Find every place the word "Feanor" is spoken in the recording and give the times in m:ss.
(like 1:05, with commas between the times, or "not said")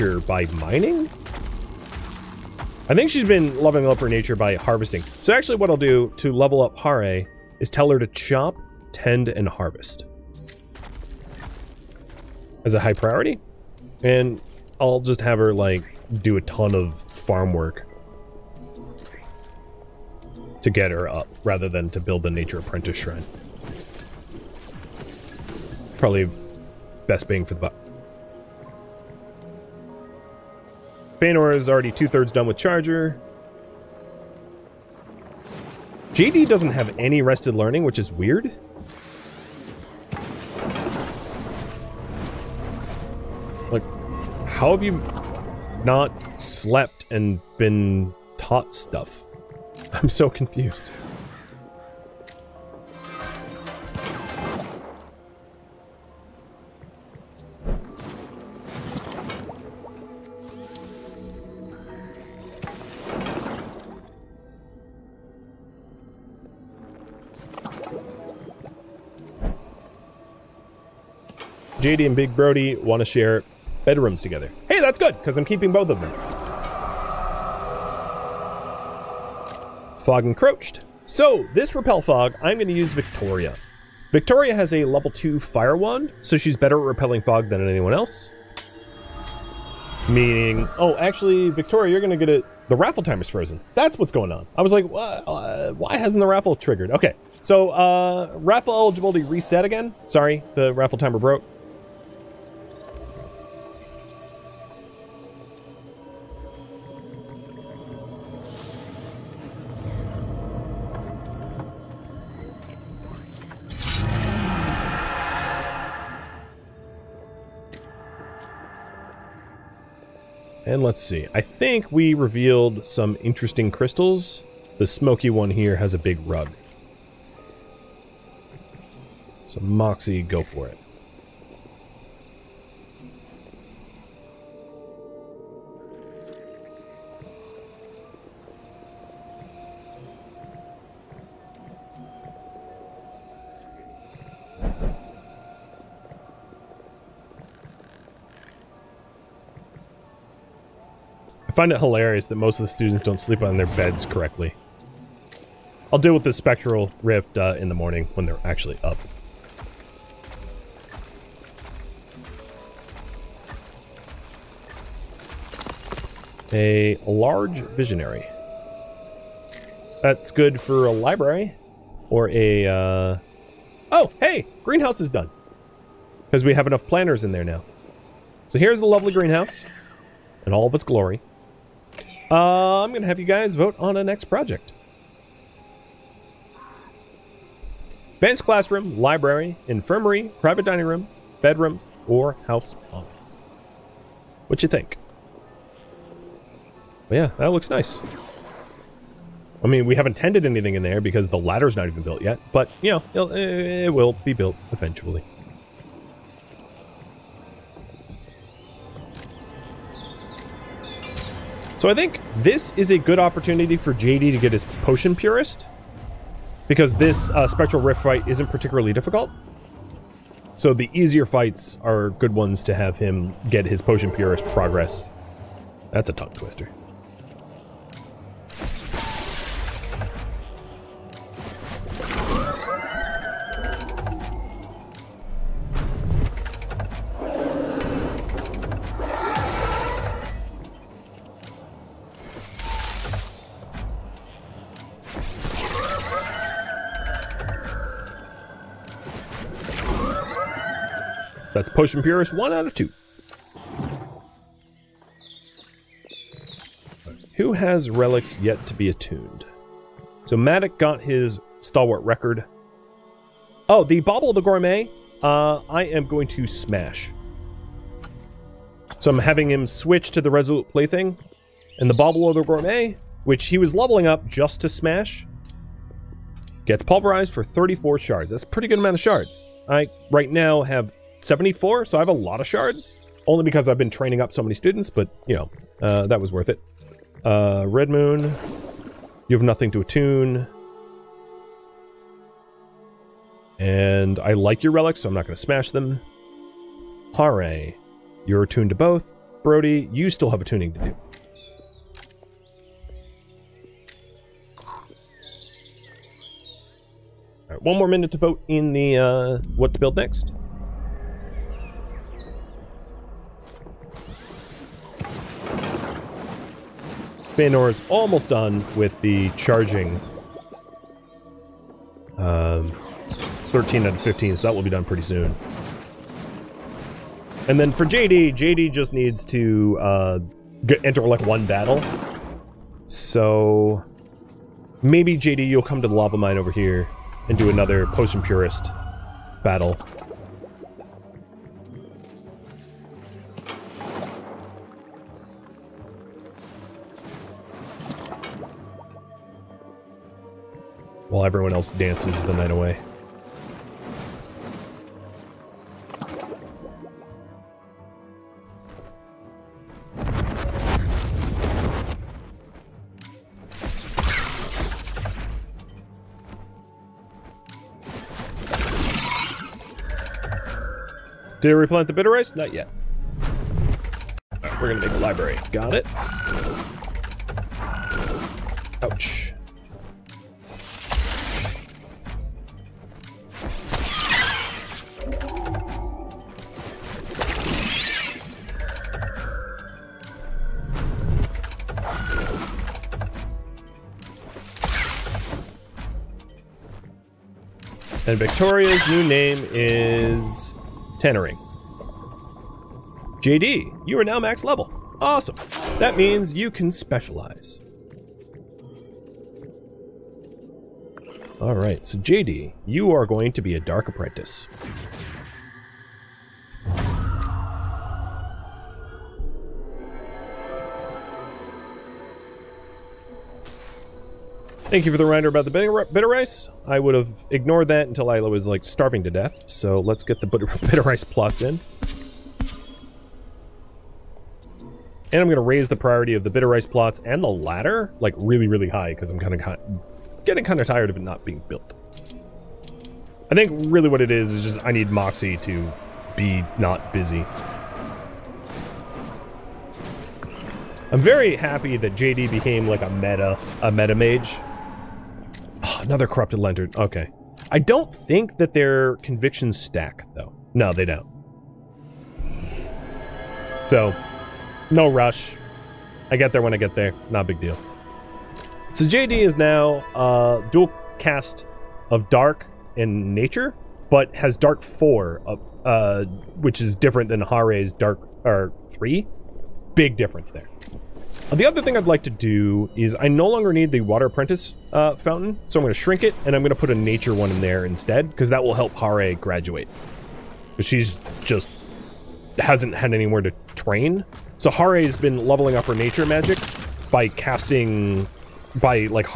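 0:31, 5:17.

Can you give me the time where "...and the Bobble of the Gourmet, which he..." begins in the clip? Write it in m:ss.
4:31.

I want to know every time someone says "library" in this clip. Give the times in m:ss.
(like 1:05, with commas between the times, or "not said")
2:50, 3:08, 6:14.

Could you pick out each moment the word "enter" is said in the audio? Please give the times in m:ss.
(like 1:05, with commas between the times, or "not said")
5:30.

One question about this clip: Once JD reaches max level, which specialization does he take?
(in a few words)
Dark Apprentice.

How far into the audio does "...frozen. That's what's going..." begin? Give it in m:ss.
1:33.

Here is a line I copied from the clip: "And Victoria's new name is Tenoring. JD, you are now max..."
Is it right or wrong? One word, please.
right.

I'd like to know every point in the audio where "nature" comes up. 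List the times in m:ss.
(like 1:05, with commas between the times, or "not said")
0:04, 0:22, 7:53, 8:06, 8:15.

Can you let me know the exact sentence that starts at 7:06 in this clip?
I would have ignored that until I was like starving to death.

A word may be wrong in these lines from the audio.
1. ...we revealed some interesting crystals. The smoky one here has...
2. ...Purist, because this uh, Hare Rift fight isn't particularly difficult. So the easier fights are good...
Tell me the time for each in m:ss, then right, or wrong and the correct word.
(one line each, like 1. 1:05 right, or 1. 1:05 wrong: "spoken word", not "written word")
1. 2:01 right
2. 3:35 wrong: "Spectral", not "Hare".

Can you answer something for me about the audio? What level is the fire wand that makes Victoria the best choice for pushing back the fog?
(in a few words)
2.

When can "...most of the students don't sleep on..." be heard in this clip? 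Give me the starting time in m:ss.
2:32.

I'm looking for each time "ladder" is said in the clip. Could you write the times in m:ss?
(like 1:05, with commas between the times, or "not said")
3:21, 7:17.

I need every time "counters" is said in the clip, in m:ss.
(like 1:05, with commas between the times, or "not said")
not said.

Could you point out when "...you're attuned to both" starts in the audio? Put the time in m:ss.
4:58.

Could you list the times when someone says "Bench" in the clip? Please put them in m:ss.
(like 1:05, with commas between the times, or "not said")
3:08.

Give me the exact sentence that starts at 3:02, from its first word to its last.
Uh, I'm going to have you guys vote on a next project.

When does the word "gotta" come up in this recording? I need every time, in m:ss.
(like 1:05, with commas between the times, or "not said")
not said.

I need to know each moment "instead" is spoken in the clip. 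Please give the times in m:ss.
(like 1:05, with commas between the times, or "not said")
8:07.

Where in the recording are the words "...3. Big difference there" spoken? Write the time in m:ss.
7:58.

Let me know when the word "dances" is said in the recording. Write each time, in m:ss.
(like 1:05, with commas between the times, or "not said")
5:51.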